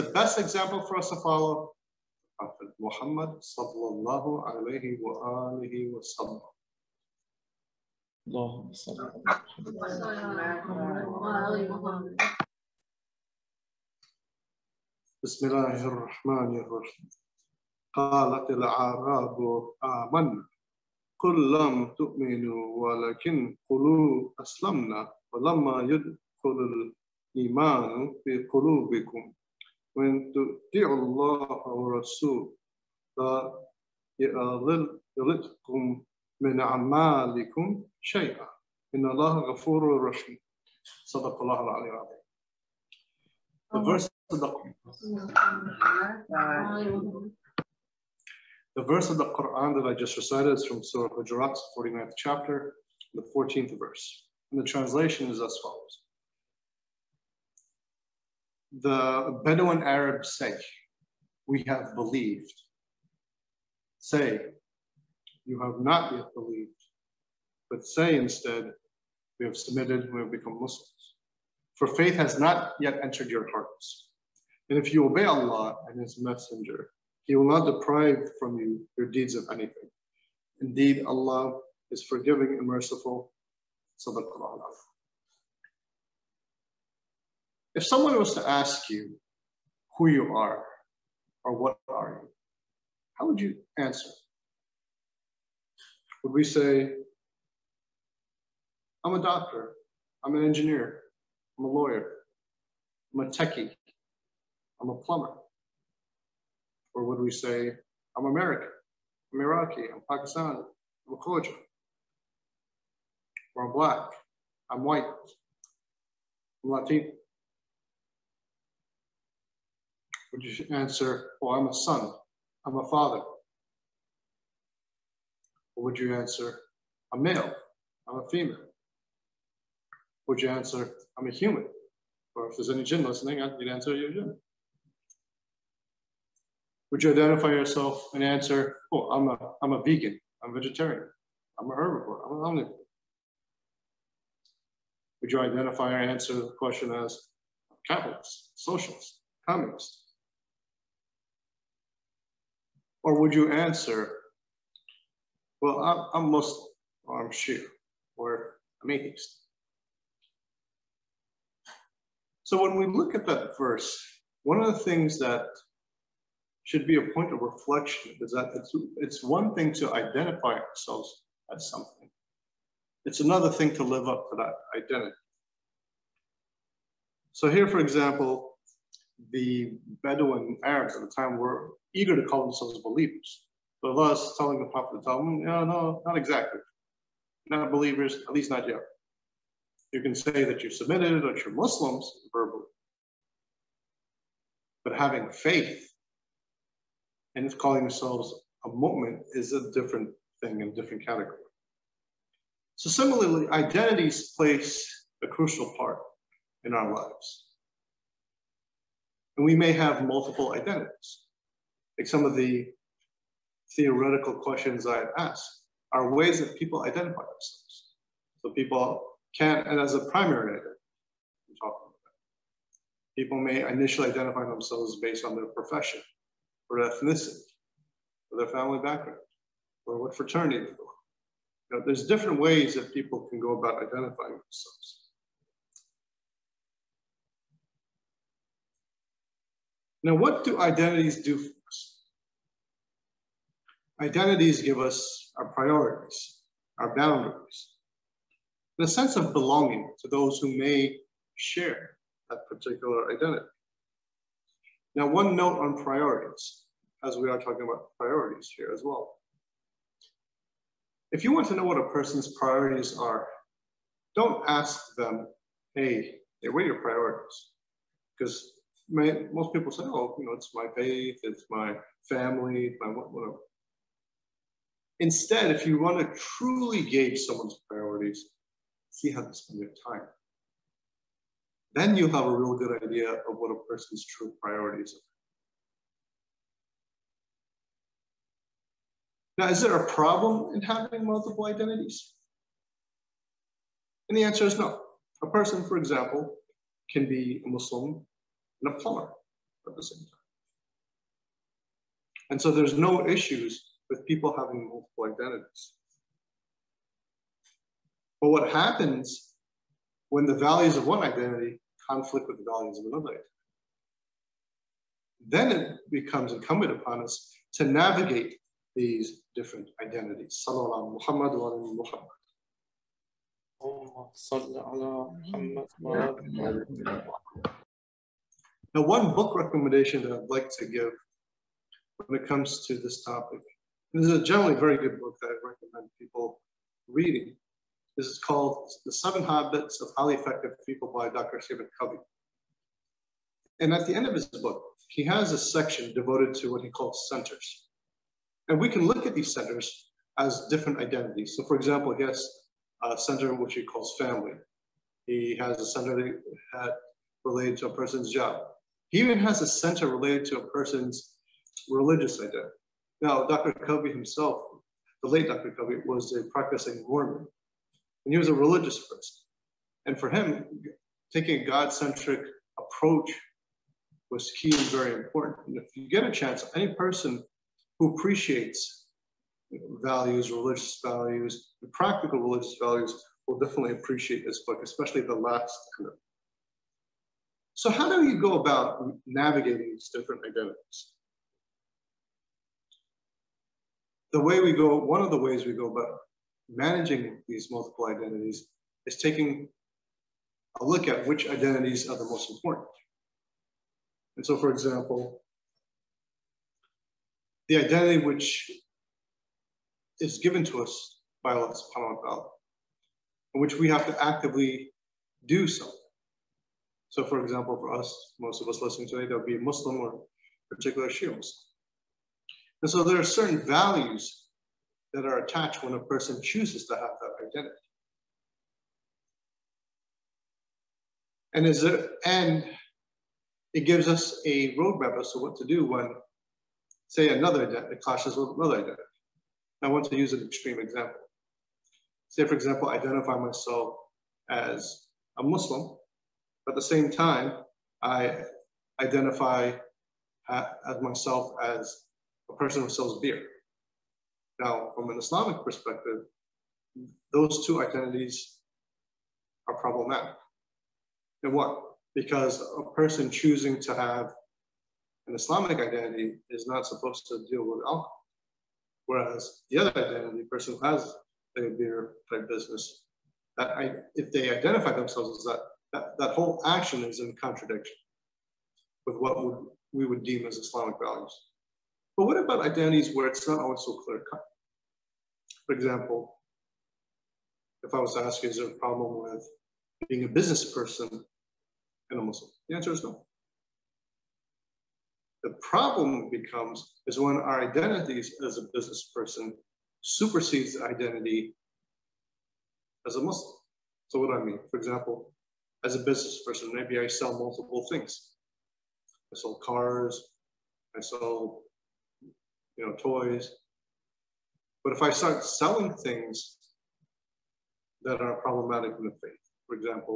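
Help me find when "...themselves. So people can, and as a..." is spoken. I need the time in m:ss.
3:37.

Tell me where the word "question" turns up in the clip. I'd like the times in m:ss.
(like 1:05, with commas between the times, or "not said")
2:26, 3:34.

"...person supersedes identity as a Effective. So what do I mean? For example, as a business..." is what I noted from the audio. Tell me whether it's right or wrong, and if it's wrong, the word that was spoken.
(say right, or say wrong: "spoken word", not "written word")
wrong: "Muslim", not "Effective".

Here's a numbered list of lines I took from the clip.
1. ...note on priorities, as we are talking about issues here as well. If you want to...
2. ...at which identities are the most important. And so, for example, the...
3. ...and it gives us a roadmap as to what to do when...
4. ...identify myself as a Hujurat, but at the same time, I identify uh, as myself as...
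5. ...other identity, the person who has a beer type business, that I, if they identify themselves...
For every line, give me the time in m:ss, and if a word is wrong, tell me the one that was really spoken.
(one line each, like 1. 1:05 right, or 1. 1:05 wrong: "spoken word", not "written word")
1. 4:15 wrong: "priorities", not "issues"
2. 6:40 right
3. 7:12 right
4. 7:22 wrong: "Muslim", not "Hujurat"
5. 7:49 right.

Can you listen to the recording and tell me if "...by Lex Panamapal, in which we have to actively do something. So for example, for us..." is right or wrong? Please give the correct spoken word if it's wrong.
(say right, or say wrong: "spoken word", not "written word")
right.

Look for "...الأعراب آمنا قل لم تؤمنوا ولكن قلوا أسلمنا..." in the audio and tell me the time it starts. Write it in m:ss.
0:18.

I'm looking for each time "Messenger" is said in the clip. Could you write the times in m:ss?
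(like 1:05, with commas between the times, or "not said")
1:16.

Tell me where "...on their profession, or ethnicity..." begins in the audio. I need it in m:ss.
3:45.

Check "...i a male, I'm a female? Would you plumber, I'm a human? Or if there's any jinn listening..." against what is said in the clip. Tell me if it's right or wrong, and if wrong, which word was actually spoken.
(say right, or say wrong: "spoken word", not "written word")
wrong: "answer", not "plumber".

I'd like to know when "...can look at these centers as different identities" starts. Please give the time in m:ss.
5:48.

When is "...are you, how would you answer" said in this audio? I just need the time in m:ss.
1:31.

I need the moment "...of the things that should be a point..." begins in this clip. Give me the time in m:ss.
2:44.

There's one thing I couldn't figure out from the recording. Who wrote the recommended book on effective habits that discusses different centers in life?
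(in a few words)
Dr. Stephen Covey.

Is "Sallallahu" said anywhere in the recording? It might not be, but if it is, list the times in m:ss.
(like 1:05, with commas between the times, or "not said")
5:20.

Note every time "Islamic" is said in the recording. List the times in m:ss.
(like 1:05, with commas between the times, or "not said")
7:34, 7:45, 8:00.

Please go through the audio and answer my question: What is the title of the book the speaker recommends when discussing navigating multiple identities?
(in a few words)
The Seven Habits of Highly Effective People.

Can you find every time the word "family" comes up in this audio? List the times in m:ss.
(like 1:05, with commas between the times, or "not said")
3:48, 4:32, 5:53.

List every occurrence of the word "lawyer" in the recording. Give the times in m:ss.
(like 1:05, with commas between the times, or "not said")
1:41.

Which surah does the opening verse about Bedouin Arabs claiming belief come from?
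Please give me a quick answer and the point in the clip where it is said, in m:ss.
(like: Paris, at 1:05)
Surah Hujurat, at 0:50.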